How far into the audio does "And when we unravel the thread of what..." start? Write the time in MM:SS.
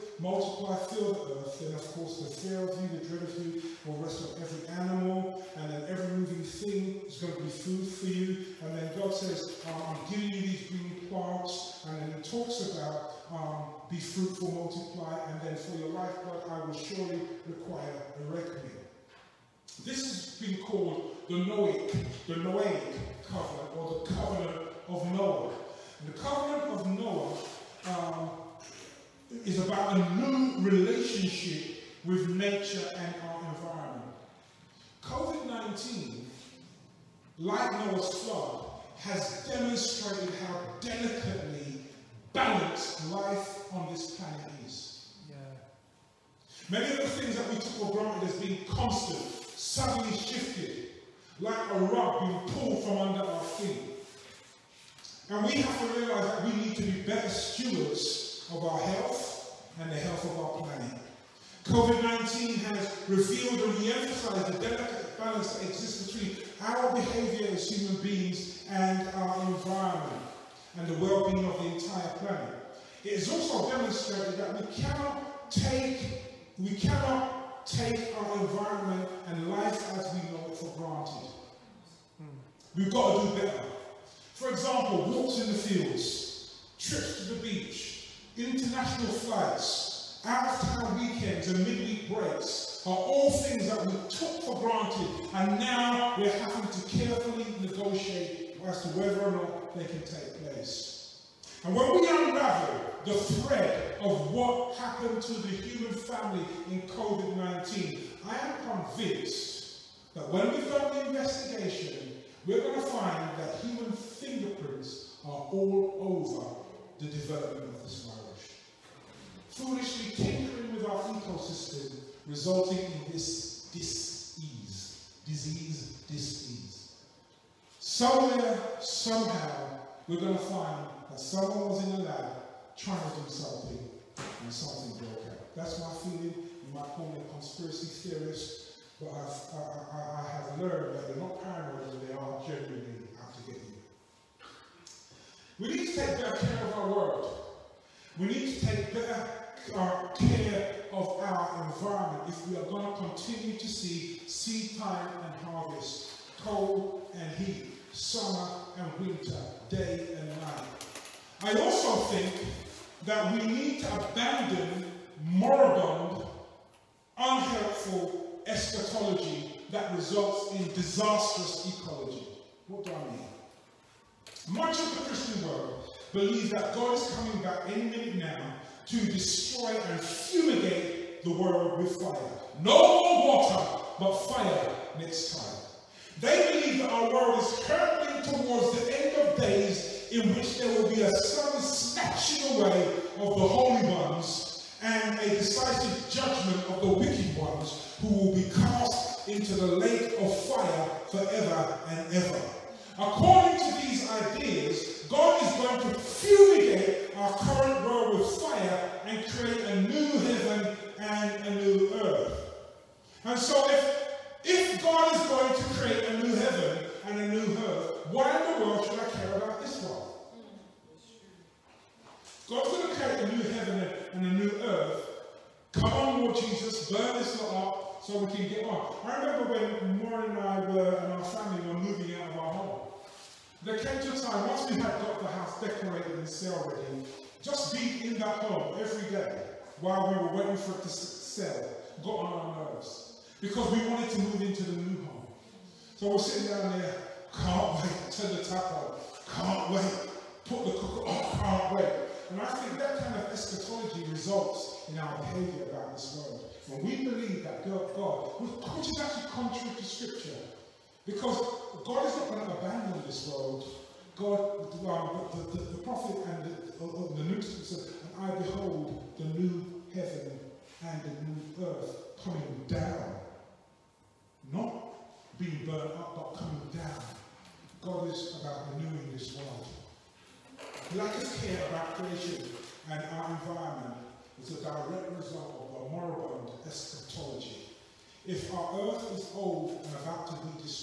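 01:41.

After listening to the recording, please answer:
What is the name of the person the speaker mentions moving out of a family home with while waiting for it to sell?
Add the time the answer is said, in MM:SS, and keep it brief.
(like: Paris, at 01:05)
Maureen, at 03:49.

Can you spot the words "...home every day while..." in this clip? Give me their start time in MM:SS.
03:58.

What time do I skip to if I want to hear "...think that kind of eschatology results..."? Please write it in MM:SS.
04:12.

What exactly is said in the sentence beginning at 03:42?
God's going to create a new heaven and a new earth.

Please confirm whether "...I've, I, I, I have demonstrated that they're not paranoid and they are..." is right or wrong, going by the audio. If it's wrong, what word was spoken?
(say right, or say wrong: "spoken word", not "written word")
wrong: "learned", not "demonstrated".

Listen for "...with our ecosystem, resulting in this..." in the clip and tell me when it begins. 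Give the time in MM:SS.
02:00.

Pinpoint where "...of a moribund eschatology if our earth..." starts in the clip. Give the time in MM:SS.
04:45.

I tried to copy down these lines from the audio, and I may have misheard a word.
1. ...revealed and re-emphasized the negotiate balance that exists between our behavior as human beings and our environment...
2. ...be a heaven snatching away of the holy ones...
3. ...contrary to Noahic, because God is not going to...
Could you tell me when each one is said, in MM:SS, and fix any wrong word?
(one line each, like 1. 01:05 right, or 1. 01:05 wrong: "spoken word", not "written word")
1. 01:03 wrong: "delicate", not "negotiate"
2. 03:10 wrong: "sudden", not "heaven"
3. 04:19 wrong: "Scripture", not "Noahic".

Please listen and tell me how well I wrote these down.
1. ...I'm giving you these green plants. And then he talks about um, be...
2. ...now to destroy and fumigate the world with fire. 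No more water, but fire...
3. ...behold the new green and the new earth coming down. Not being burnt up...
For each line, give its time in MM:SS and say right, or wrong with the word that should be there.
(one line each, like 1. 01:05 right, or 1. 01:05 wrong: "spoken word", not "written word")
1. 00:09 right
2. 02:58 right
3. 04:28 wrong: "heaven", not "green".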